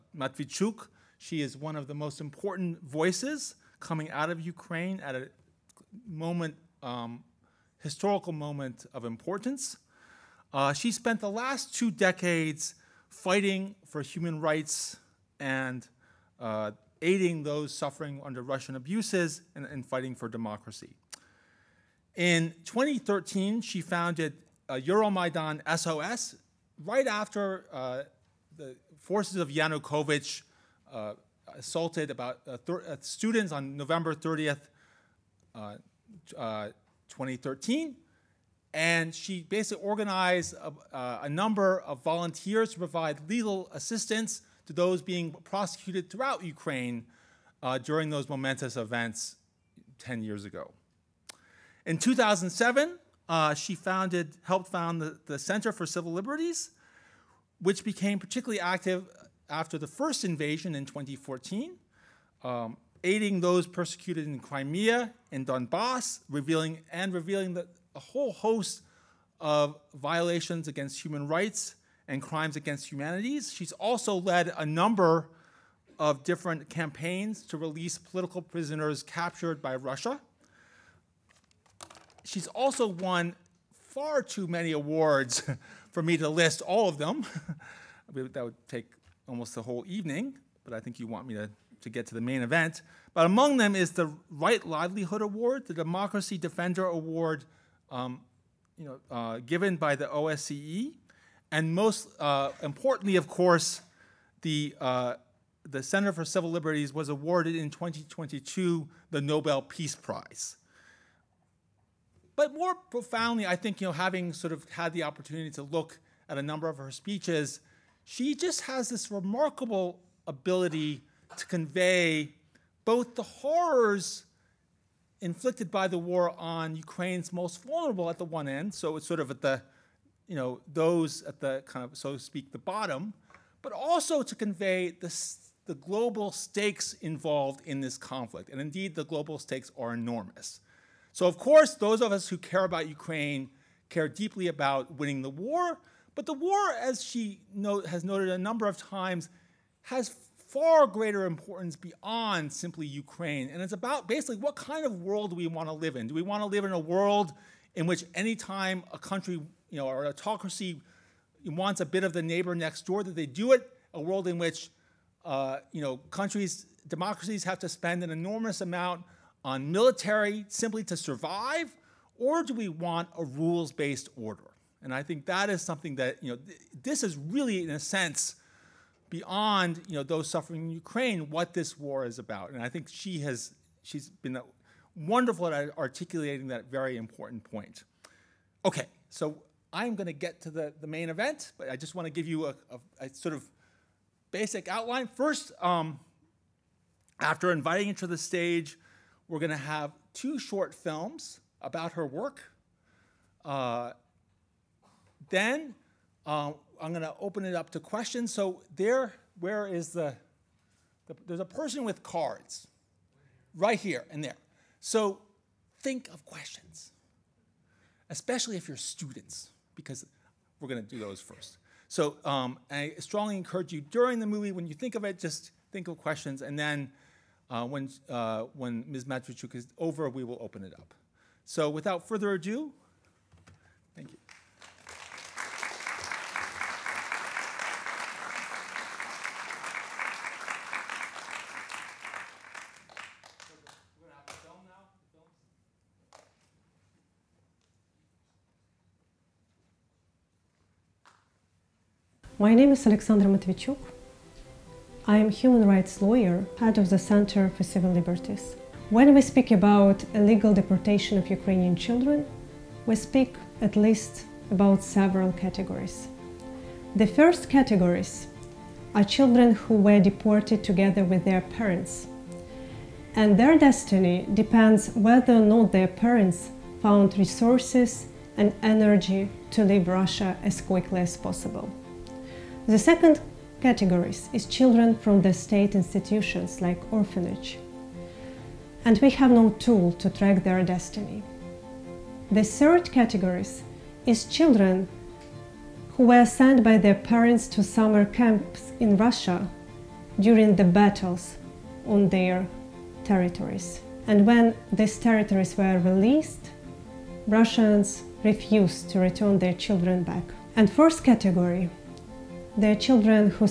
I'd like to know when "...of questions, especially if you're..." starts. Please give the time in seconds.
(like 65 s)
216 s.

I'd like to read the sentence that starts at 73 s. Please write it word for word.
She's also led a number of different campaigns to release political prisoners captured by Russia.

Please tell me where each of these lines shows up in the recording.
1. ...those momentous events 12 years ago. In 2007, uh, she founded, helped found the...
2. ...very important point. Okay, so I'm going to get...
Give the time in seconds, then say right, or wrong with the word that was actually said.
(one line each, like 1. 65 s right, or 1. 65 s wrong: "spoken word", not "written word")
1. 48 s wrong: "10", not "12"
2. 186 s right.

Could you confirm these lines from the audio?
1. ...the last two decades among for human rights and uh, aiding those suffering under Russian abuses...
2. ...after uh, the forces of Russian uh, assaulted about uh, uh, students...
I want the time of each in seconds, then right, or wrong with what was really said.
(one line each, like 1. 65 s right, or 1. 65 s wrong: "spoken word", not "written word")
1. 11 s wrong: "fighting", not "among"
2. 27 s wrong: "Yanukovych", not "Russian".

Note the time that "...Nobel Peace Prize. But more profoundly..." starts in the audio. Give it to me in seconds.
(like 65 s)
109 s.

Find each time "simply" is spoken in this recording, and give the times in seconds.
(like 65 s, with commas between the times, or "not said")
152 s, 170 s.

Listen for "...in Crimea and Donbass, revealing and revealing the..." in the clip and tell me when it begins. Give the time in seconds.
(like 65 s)
64 s.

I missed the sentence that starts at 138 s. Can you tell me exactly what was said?
And indeed, the global stakes are enormous.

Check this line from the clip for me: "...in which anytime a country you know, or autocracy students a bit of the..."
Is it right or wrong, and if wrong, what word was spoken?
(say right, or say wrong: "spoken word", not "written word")
wrong: "wants", not "students".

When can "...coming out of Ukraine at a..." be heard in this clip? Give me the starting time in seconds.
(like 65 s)
3 s.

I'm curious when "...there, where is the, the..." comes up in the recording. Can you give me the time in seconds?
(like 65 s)
208 s.